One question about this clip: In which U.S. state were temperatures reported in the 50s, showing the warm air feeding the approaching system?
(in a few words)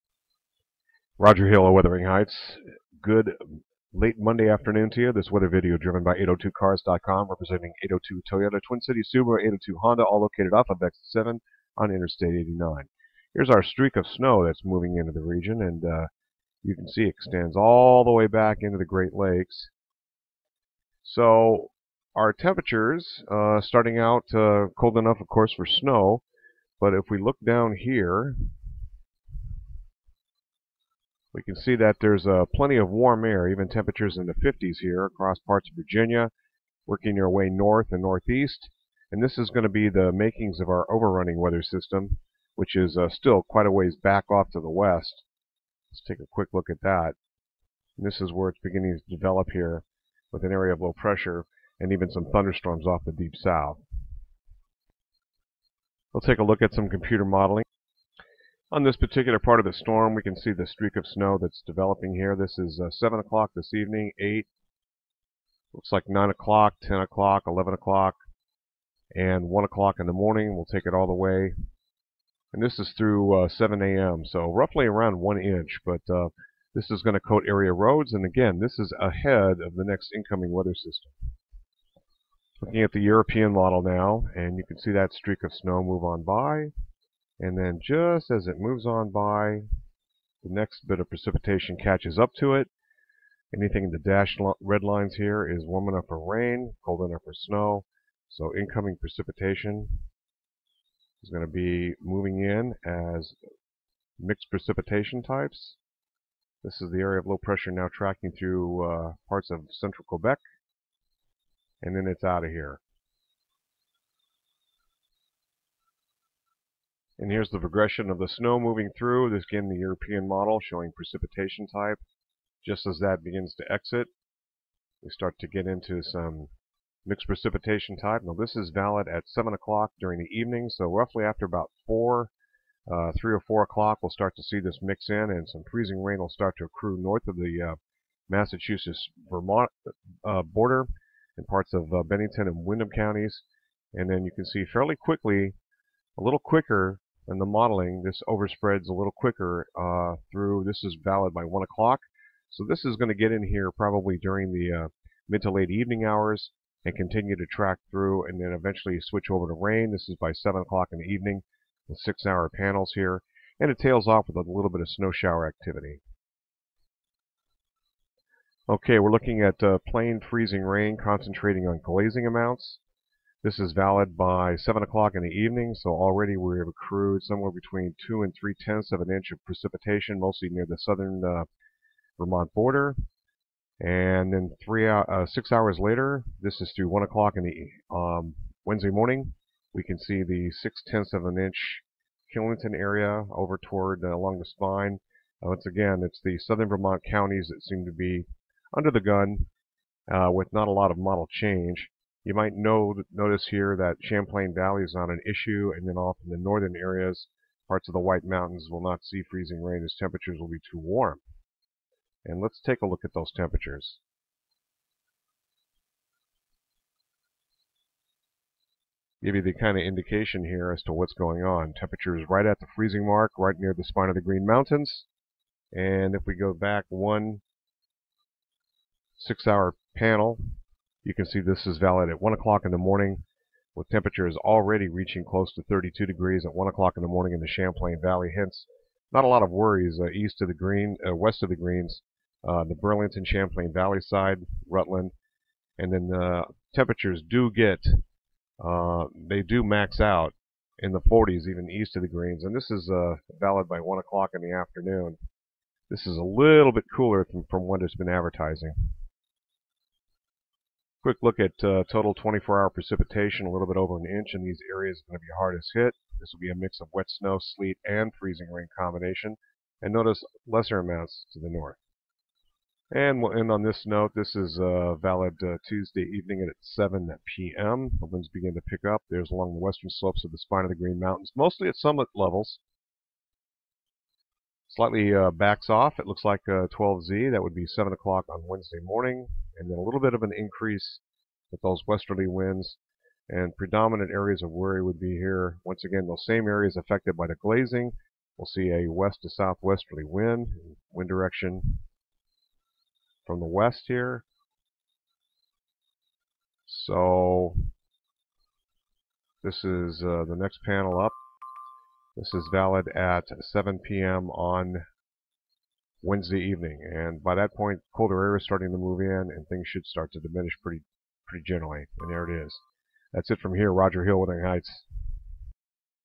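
Virginia.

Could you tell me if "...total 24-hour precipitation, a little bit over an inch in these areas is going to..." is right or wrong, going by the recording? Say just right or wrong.
right.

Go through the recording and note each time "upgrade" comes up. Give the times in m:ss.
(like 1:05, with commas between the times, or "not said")
not said.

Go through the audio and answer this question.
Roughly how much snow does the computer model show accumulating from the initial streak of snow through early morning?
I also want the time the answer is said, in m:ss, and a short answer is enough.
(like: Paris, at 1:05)
1 inch, at 1:15.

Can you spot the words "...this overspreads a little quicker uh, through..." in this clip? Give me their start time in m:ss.
2:28.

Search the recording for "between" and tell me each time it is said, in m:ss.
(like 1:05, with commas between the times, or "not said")
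2:57.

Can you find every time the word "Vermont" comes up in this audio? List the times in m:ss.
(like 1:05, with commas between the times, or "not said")
2:18, 3:02, 3:16.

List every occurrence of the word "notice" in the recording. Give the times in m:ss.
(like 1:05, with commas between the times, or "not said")
3:23, 4:29.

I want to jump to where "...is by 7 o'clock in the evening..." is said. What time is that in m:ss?
2:40.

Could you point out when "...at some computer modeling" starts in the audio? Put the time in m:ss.
0:56.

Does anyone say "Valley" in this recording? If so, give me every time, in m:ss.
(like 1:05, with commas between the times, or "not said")
3:24, 3:58, 4:03.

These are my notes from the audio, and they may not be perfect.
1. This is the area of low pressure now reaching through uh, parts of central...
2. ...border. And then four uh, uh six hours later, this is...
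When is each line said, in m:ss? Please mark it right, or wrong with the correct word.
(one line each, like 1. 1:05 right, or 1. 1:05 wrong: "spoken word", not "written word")
1. 1:46 wrong: "tracking", not "reaching"
2. 3:02 wrong: "three", not "four".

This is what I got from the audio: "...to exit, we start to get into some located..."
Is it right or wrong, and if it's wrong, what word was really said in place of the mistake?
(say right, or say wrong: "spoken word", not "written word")
wrong: "mixed", not "located".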